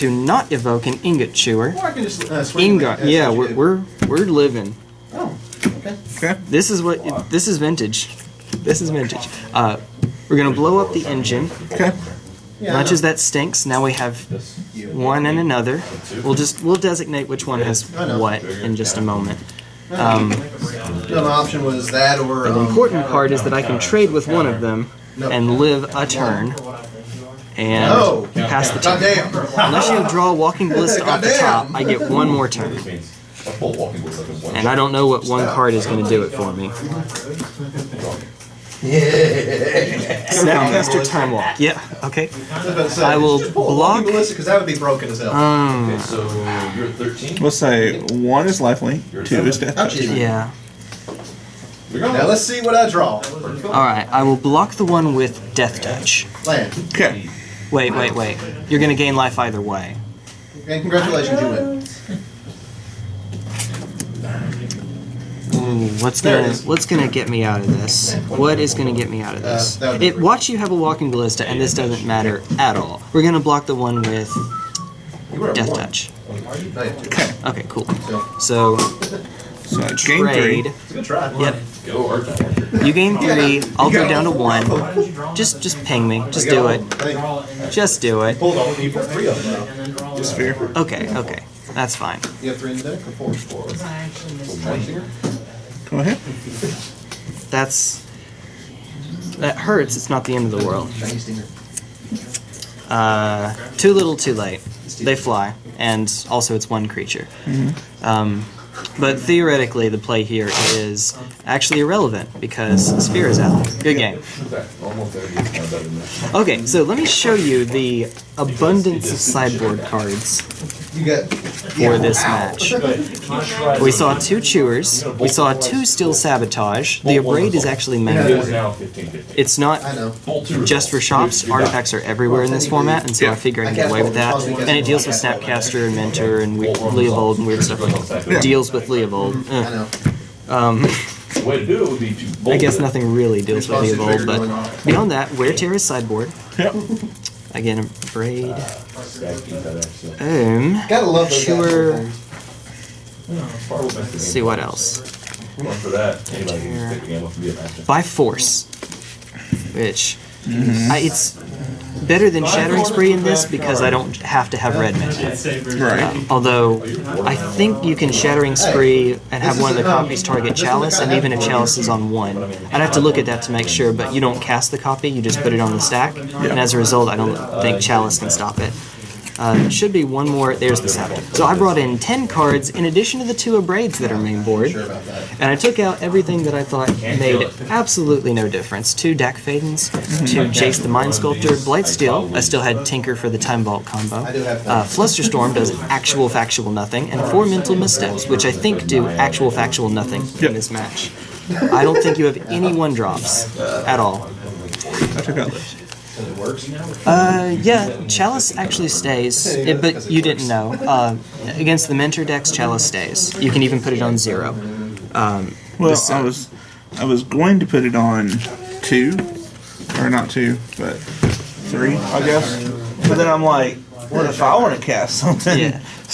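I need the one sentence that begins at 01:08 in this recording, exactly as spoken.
What is gonna get me out of uh, this?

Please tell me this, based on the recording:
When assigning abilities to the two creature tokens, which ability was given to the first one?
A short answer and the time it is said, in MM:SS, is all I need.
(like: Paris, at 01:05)
Lifelink, at 00:48.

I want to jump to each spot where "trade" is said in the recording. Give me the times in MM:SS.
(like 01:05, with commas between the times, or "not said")
00:23, 01:20.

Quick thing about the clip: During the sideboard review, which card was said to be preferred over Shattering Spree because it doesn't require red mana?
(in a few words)
By Force.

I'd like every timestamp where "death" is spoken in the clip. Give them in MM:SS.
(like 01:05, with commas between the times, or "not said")
00:49, 00:55, 01:15.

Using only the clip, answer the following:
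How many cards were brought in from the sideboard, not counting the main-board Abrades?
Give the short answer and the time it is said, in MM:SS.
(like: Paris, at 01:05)
10, at 03:01.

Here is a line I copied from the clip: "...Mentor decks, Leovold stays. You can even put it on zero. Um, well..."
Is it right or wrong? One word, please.
wrong.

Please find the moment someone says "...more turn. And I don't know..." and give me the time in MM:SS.
00:32.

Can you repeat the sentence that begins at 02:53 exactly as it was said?
But you don't cast the copy; you just put it on the stack, yeah.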